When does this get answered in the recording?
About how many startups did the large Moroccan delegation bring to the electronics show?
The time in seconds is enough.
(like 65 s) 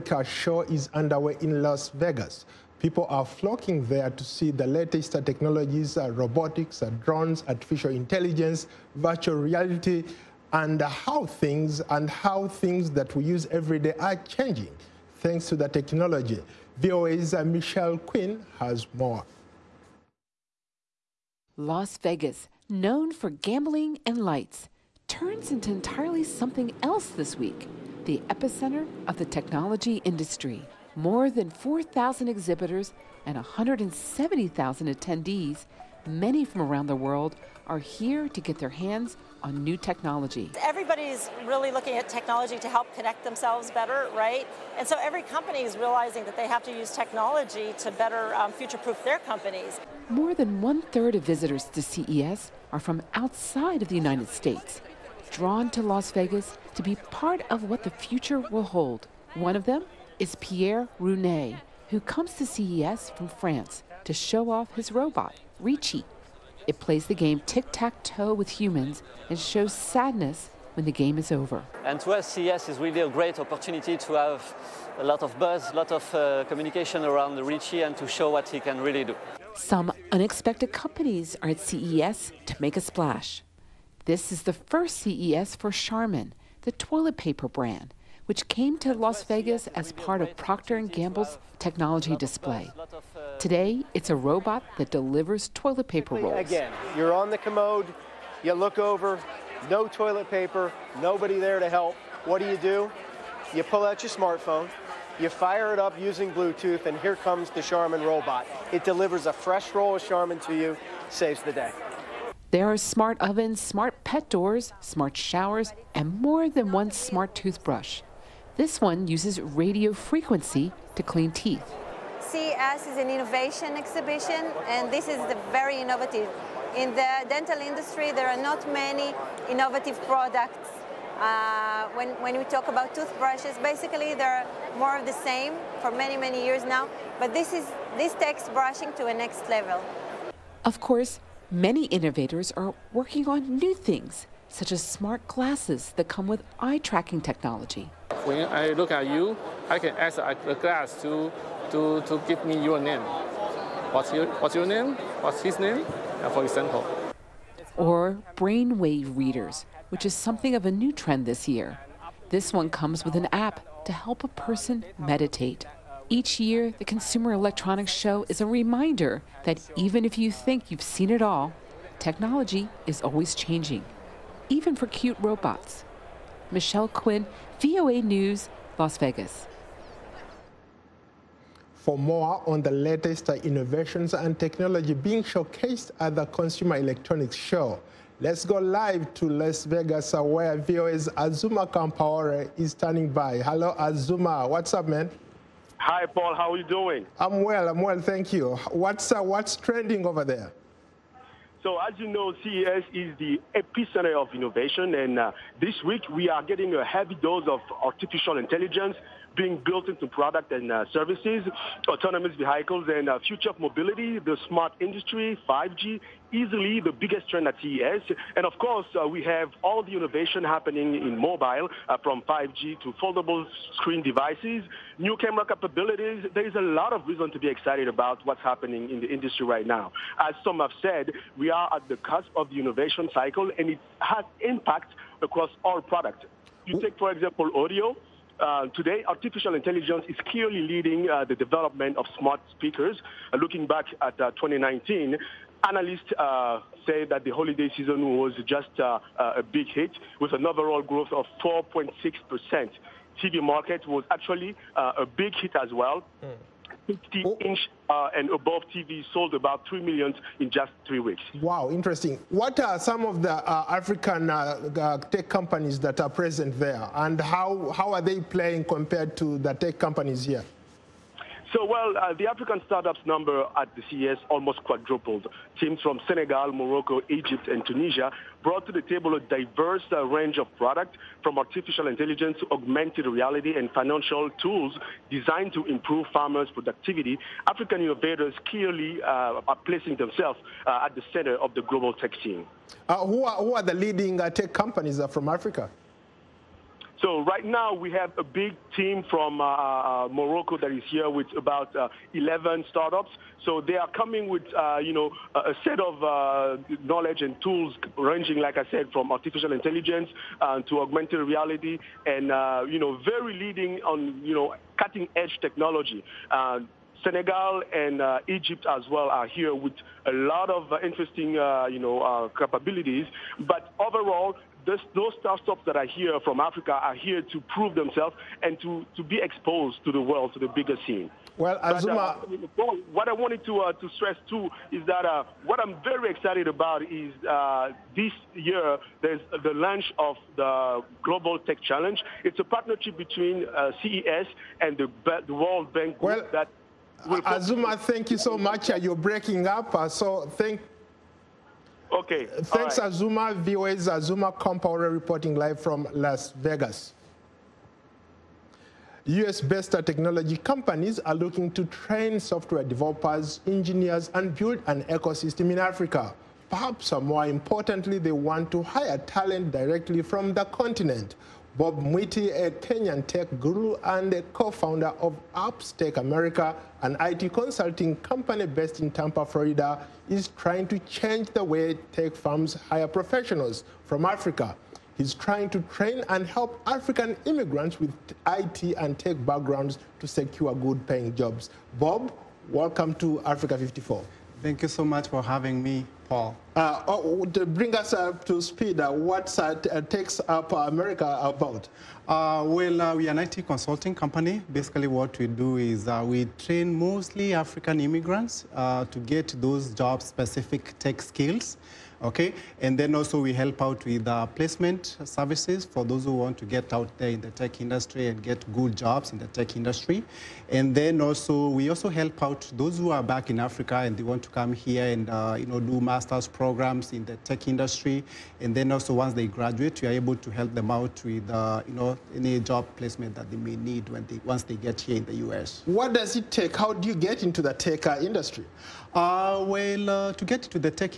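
302 s.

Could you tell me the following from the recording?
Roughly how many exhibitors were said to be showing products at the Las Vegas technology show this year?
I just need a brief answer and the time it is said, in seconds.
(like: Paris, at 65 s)
4,000, at 31 s.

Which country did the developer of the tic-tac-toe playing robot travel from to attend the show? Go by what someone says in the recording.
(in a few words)
France.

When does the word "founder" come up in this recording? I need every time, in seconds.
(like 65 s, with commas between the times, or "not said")
374 s.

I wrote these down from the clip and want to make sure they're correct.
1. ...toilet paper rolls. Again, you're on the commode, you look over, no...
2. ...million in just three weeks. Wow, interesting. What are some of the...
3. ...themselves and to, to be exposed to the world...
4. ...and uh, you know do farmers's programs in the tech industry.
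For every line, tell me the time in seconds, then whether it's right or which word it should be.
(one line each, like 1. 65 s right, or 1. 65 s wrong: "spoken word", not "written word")
1. 95 s right
2. 259 s right
3. 327 s right
4. 424 s wrong: "master", not "farmers".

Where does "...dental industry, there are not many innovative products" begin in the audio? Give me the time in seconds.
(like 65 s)
127 s.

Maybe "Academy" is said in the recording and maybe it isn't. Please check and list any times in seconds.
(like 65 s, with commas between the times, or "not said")
not said.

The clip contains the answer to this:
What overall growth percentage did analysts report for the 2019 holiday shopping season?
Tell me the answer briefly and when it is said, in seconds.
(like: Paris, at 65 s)
4.6%, at 251 s.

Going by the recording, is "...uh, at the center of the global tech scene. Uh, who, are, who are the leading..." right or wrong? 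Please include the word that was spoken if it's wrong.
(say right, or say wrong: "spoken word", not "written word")
right.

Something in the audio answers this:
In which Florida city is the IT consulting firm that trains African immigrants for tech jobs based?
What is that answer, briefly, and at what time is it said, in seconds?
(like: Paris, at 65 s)
Tampa, at 378 s.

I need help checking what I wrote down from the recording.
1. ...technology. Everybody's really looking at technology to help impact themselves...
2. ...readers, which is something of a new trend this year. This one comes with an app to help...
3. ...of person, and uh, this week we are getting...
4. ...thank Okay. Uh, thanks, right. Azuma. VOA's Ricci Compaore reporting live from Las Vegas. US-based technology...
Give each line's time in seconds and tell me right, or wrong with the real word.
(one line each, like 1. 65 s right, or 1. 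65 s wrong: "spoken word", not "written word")
1. 39 s wrong: "connect", not "impact"
2. 159 s right
3. 204 s wrong: "innovation", not "person"
4. 350 s wrong: "Azuma", not "Ricci".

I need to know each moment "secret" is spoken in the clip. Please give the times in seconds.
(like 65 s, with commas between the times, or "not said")
not said.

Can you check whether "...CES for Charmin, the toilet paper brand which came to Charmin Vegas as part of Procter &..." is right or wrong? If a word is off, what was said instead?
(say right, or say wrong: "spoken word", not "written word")
wrong: "Las", not "Charmin".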